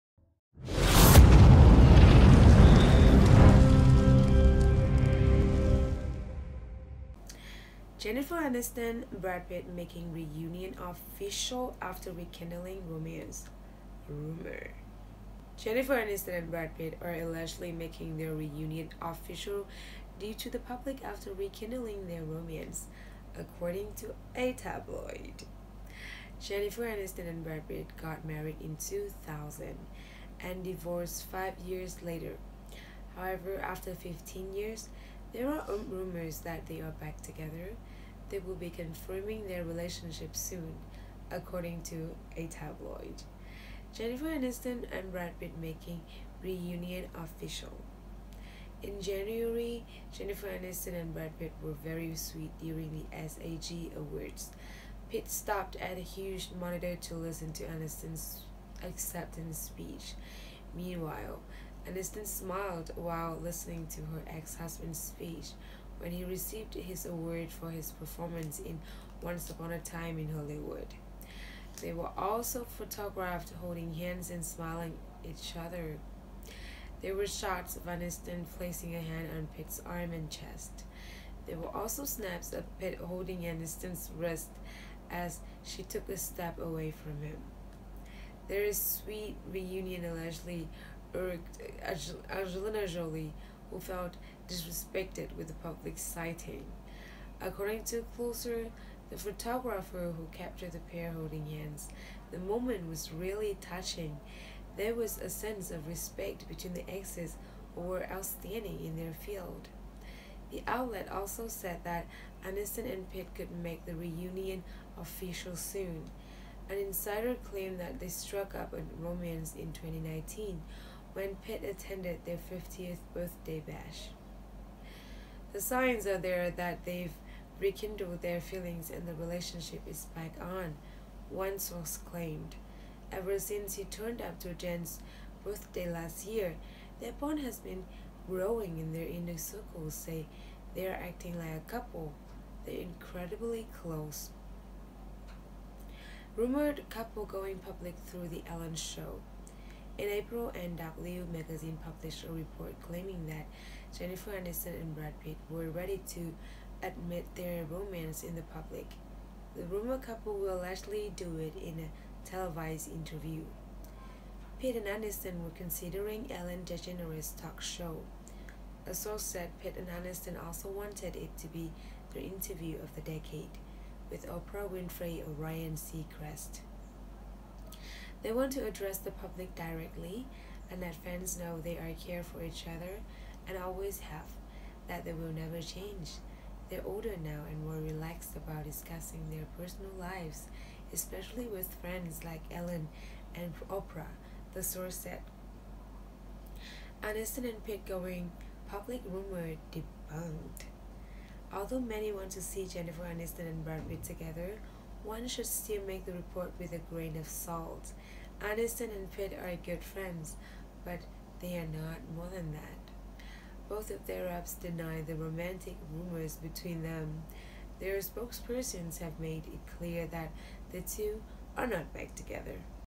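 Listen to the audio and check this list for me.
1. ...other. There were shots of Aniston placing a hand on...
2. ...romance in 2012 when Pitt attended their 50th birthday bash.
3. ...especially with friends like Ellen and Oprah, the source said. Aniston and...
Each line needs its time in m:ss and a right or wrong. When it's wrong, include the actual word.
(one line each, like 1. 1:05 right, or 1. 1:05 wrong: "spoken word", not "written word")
1. 1:15 right
2. 1:59 wrong: "2019", not "2012"
3. 3:10 right.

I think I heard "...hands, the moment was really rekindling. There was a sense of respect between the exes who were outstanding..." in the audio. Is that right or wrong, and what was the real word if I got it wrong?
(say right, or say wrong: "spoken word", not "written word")
wrong: "touching", not "rekindling".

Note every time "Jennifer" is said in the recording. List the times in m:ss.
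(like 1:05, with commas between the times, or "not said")
0:08, 0:15, 0:26, 0:43, 0:50, 2:33, 3:22.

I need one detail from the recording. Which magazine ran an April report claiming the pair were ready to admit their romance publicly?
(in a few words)
NW.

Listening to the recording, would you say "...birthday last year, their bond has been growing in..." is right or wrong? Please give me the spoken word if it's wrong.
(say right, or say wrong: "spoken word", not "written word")
right.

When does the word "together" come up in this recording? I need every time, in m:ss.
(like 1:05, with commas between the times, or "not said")
0:37, 3:24, 3:42.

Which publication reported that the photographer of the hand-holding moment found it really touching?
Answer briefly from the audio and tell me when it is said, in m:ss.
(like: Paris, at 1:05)
Closer, at 1:38.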